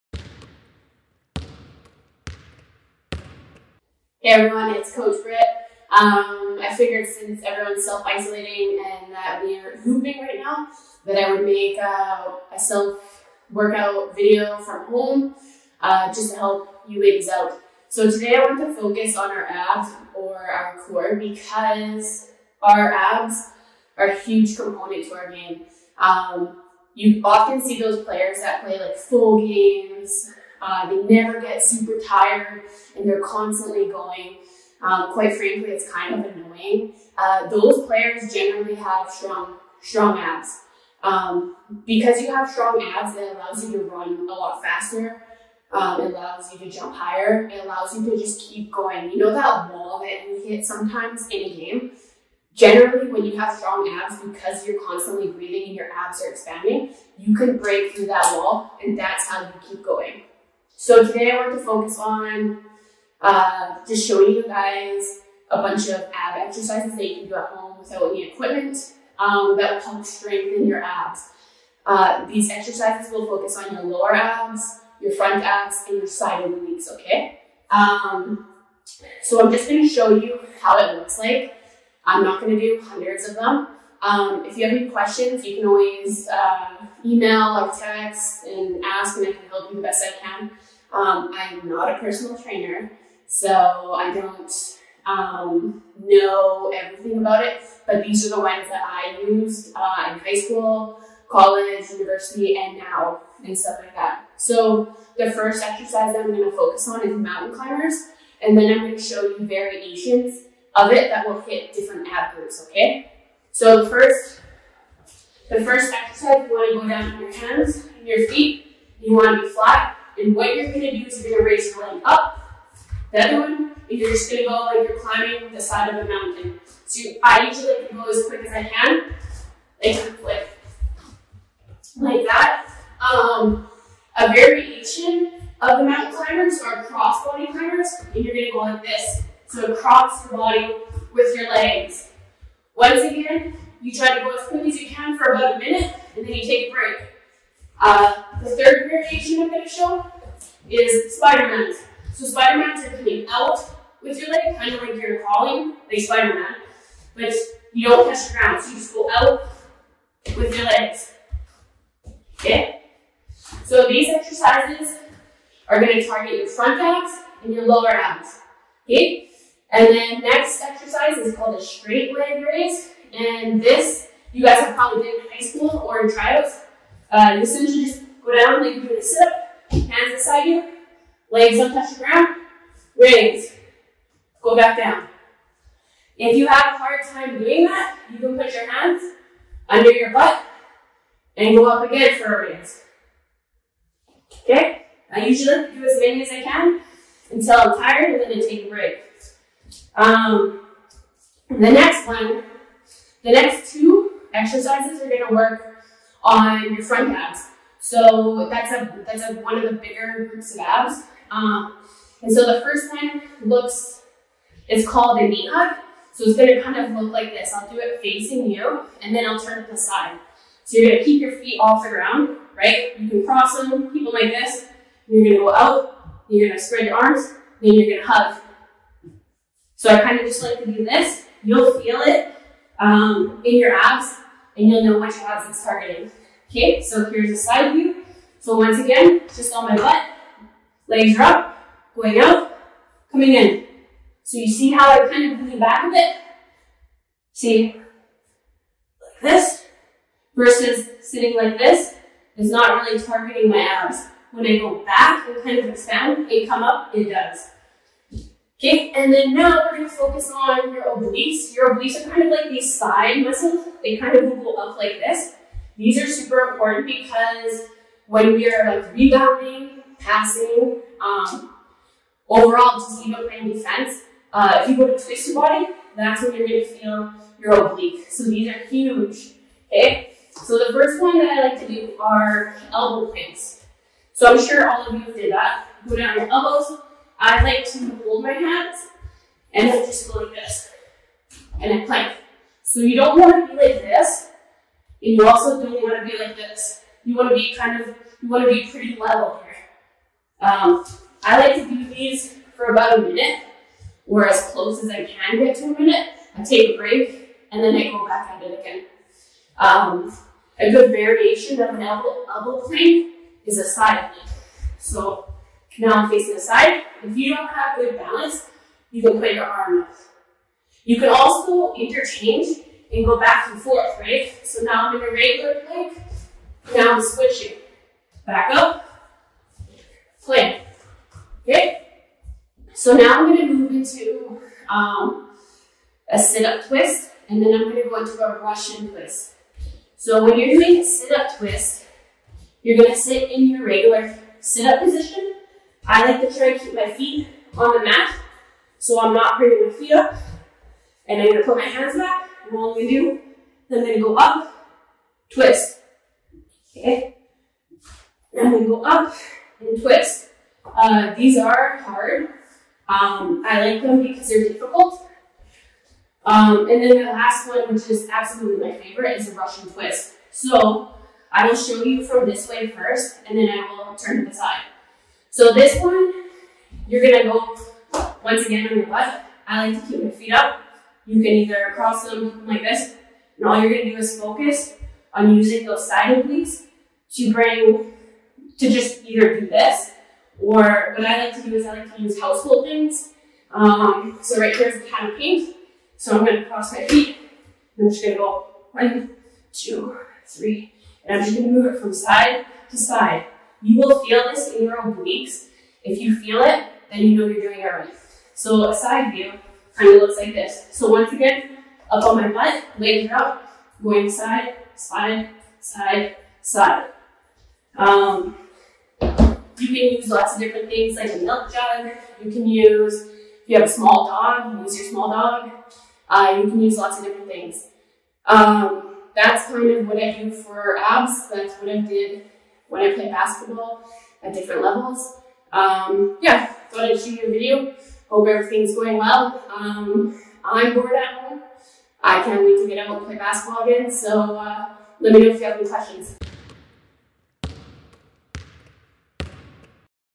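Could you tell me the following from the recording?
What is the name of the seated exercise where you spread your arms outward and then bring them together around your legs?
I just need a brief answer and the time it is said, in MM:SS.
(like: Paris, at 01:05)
knee hug, at 03:35.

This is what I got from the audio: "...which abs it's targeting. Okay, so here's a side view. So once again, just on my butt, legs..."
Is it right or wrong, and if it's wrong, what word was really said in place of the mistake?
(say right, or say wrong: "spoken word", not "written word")
right.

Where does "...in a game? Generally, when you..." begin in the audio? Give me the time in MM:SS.
00:51.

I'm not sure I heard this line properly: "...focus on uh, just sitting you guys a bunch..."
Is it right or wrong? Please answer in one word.
wrong.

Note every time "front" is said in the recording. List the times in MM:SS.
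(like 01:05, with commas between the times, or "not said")
01:15, 02:46, 03:26.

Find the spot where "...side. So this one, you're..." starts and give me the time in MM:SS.
06:14.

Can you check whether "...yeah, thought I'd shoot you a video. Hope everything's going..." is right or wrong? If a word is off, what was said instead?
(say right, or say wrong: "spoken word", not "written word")
right.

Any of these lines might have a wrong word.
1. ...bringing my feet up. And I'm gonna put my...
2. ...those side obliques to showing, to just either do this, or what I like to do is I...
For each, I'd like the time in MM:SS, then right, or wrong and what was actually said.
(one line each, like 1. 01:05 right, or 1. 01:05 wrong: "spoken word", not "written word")
1. 05:49 right
2. 06:25 wrong: "bring", not "showing".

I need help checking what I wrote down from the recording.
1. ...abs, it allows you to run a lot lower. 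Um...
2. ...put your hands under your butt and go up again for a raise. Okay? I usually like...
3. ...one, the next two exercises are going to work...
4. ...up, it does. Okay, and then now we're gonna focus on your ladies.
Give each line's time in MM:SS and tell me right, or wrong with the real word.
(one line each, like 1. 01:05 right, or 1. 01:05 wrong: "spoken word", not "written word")
1. 00:42 wrong: "faster", not "lower"
2. 03:08 right
3. 03:22 right
4. 04:16 wrong: "obliques", not "ladies".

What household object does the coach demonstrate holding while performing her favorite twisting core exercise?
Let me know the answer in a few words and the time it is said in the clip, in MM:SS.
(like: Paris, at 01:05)
a can of paint, at 06:34.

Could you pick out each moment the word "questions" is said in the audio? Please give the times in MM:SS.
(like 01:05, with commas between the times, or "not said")
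01:24, 07:25.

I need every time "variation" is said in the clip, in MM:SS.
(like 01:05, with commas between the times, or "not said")
01:49, 02:14, 02:28, 05:10.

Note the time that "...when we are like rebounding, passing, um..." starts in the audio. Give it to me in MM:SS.
04:28.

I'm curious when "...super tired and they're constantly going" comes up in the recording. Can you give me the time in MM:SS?
00:31.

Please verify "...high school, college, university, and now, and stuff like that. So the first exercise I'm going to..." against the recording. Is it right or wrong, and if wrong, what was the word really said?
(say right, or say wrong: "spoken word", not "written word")
right.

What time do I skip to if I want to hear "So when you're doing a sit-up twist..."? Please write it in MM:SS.
05:39.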